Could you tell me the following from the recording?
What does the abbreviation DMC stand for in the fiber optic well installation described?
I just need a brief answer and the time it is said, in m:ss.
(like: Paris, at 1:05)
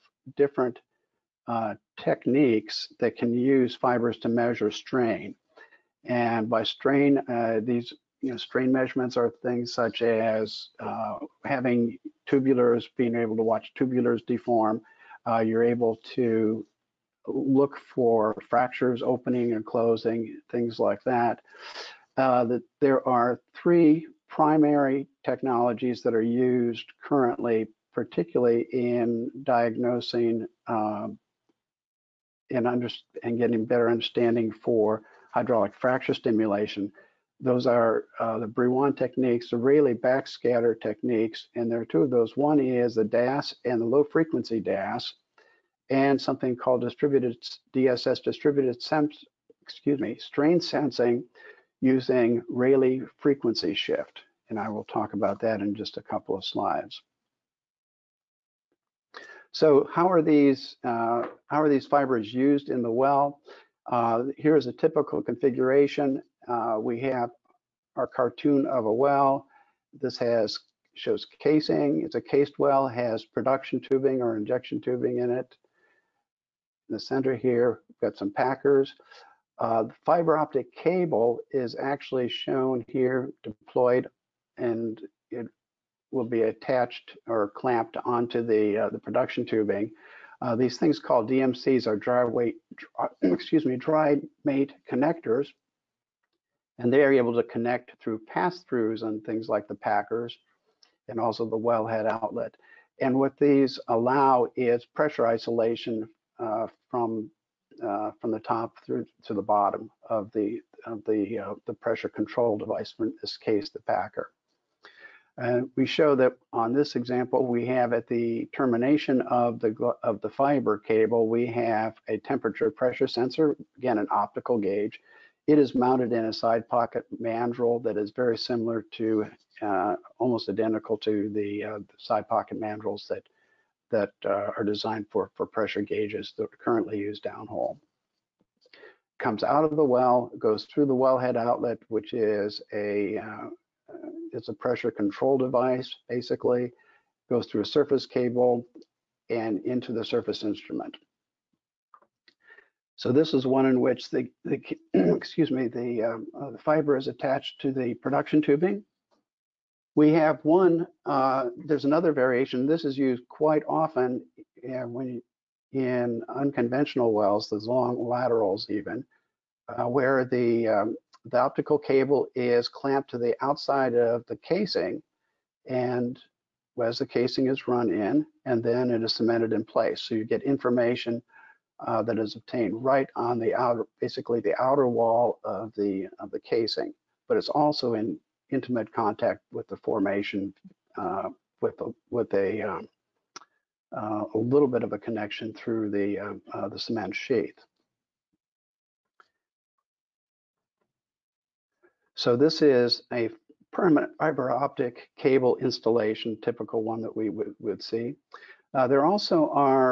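Dry mate connectors, at 1:33.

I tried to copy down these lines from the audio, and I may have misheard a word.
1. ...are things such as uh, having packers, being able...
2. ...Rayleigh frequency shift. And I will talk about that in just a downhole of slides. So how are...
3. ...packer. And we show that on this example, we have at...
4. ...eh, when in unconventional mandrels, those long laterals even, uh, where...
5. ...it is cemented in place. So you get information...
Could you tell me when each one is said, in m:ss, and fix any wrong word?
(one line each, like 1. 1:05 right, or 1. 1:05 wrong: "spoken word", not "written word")
1. 0:09 wrong: "tubulars", not "packers"
2. 0:52 wrong: "couple", not "downhole"
3. 1:53 right
4. 2:44 wrong: "wells", not "mandrels"
5. 2:58 right.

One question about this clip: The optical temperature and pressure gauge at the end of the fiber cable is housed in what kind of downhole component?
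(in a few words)
Side pocket mandrel.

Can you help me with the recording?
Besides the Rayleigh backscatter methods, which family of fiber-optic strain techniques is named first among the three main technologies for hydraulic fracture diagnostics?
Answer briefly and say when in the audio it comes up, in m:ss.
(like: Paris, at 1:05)
Brillouin techniques, at 0:38.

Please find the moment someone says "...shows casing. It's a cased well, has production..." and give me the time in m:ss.
1:10.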